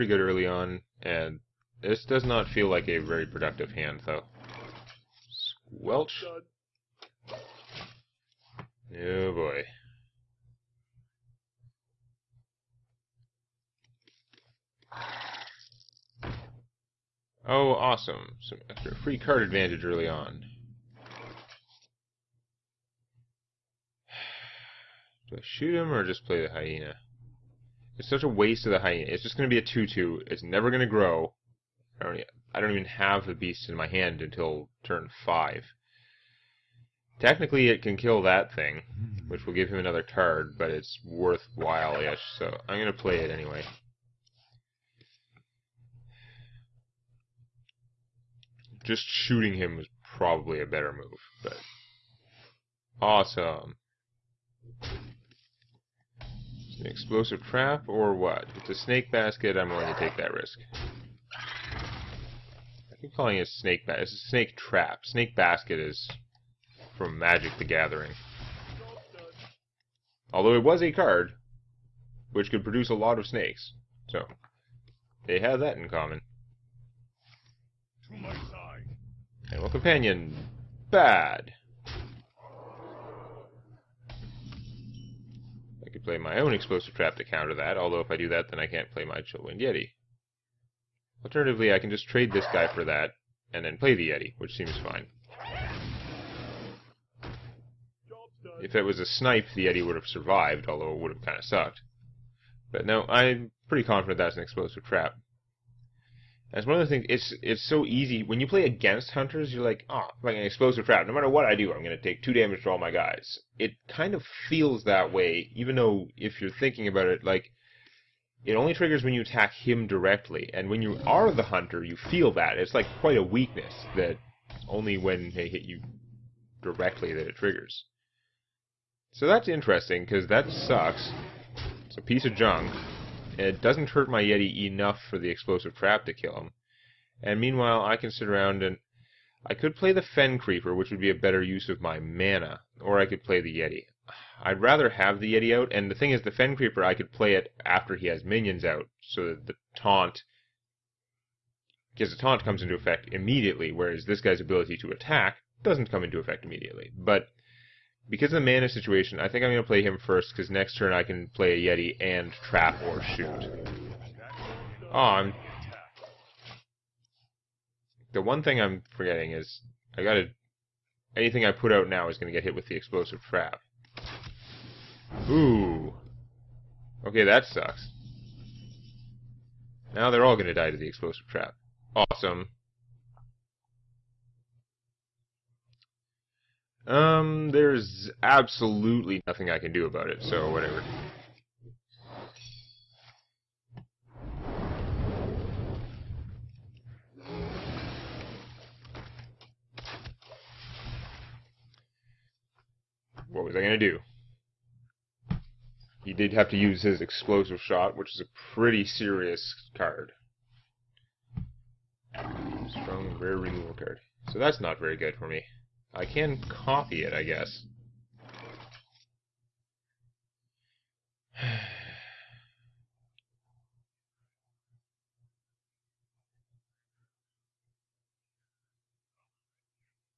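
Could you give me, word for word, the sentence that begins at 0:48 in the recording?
Just shooting him was probably a better move, but...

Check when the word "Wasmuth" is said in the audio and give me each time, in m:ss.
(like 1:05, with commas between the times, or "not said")
not said.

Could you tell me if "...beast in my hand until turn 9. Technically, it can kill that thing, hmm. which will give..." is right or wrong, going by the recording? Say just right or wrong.
wrong.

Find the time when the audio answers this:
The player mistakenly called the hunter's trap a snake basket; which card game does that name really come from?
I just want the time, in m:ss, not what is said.
1:07.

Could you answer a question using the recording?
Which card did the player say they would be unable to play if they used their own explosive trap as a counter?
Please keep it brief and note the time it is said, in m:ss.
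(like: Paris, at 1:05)
Chillwind Yeti, at 1:29.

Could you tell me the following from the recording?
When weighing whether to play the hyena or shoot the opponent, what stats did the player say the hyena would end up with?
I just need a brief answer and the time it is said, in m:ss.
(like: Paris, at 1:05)
2-2, at 0:29.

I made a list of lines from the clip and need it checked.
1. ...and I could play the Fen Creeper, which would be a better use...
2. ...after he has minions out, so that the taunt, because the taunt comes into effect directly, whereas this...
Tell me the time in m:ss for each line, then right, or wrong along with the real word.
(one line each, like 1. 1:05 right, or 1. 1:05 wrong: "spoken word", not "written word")
1. 2:18 right
2. 2:27 wrong: "immediately", not "directly".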